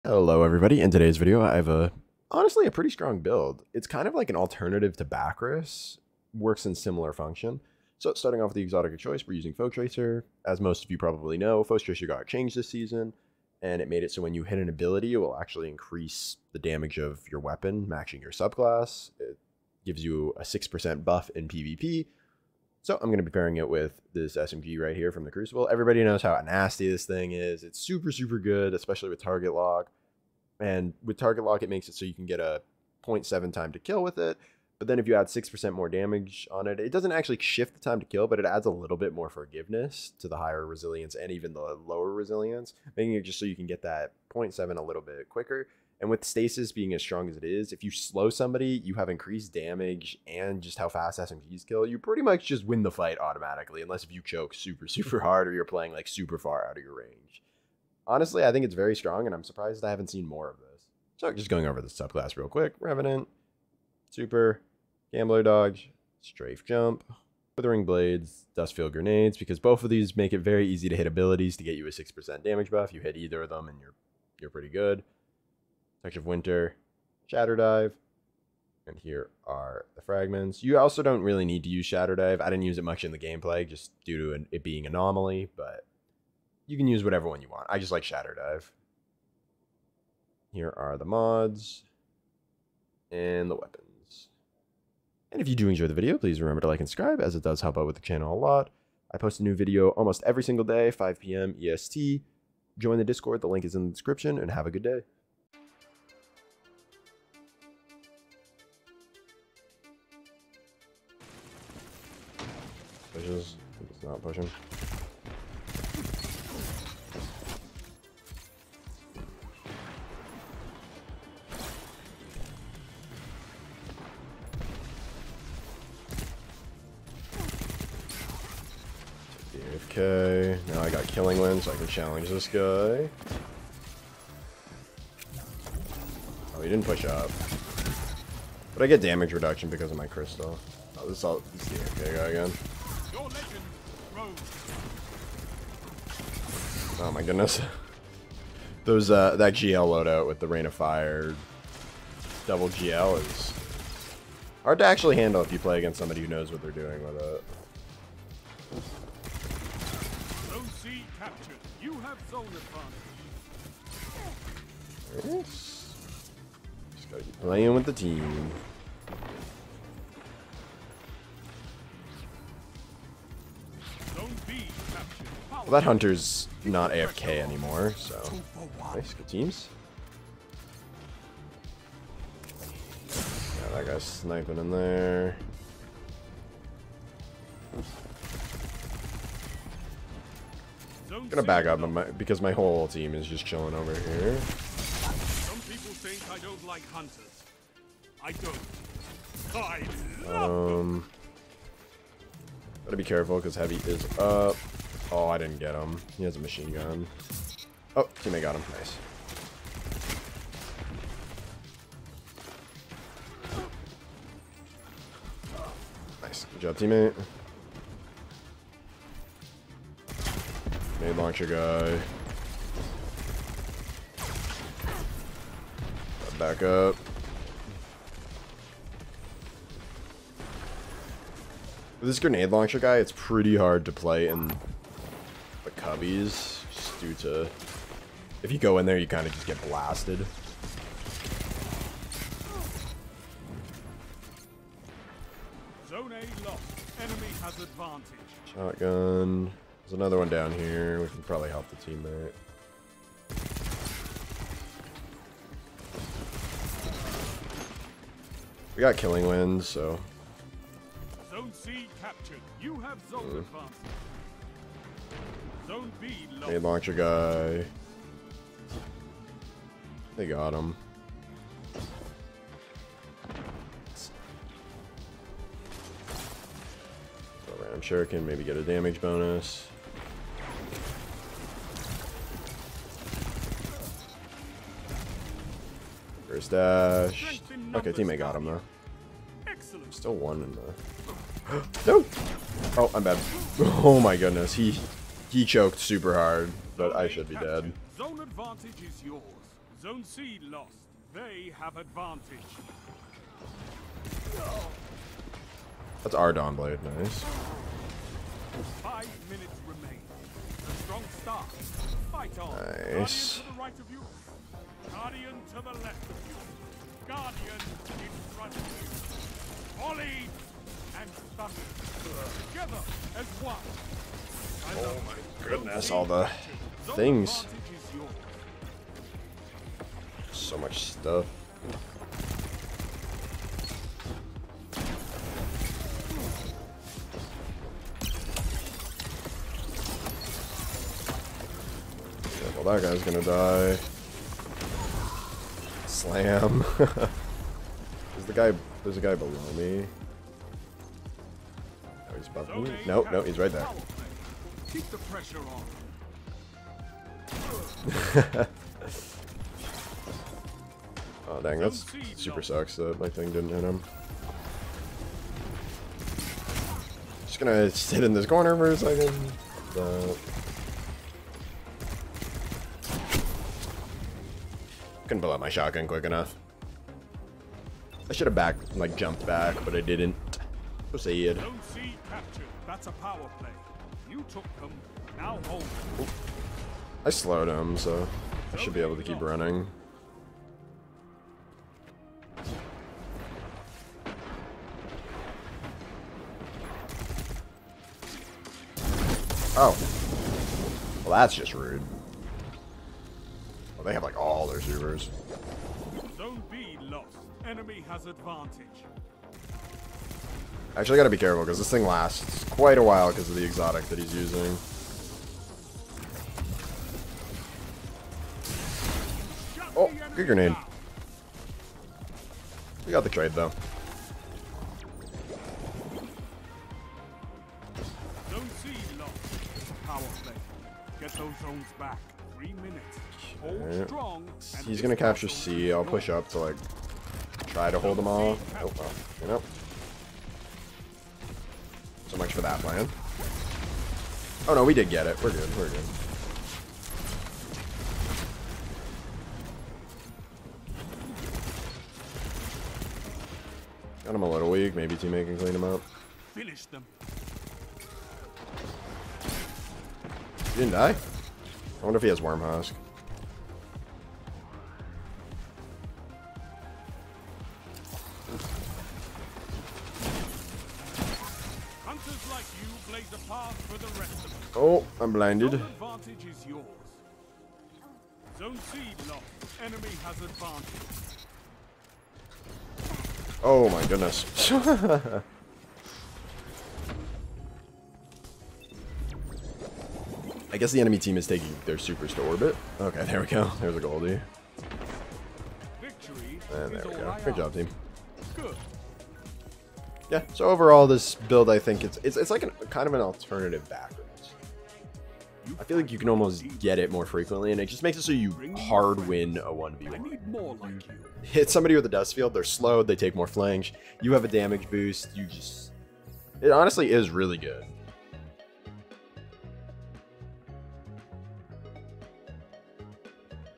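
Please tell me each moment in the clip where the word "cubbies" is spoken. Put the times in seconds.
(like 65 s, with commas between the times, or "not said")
235 s.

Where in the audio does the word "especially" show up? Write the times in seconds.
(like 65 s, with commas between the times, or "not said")
28 s.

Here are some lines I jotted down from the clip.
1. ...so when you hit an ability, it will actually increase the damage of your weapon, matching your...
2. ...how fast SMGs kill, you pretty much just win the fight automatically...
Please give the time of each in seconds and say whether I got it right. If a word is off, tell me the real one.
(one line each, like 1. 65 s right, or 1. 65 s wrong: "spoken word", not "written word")
1. 14 s right
2. 50 s right.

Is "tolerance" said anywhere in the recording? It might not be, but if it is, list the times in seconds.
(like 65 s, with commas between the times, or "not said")
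not said.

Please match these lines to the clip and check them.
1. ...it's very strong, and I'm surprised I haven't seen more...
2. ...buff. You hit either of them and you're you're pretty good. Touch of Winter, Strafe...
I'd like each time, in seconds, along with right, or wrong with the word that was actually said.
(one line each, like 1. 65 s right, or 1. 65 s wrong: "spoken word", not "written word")
1. 58 s right
2. 72 s wrong: "Shatter", not "Strafe".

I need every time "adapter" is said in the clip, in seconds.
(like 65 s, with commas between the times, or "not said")
not said.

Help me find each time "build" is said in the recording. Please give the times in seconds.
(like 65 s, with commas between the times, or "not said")
3 s, 501 s.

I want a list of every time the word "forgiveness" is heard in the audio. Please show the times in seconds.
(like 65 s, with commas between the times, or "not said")
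39 s.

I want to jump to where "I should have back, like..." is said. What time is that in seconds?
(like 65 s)
378 s.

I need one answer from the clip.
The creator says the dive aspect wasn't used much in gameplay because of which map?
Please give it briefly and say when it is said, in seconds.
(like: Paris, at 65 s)
Anomaly, at 84 s.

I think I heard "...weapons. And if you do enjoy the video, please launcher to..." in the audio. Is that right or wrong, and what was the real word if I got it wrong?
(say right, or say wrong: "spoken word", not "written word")
wrong: "remember", not "launcher".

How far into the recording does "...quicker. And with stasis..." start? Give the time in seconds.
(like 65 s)
45 s.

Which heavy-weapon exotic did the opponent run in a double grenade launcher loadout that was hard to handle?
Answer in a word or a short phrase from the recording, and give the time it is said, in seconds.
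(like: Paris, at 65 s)
Rain of Fire, at 150 s.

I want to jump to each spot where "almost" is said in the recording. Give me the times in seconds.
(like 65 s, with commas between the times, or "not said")
99 s, 506 s.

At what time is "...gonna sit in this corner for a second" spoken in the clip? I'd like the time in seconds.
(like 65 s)
367 s.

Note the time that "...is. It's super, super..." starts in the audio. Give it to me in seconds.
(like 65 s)
27 s.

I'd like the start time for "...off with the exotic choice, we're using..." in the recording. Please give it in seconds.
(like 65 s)
8 s.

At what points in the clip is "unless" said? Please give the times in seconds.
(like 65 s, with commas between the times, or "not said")
53 s.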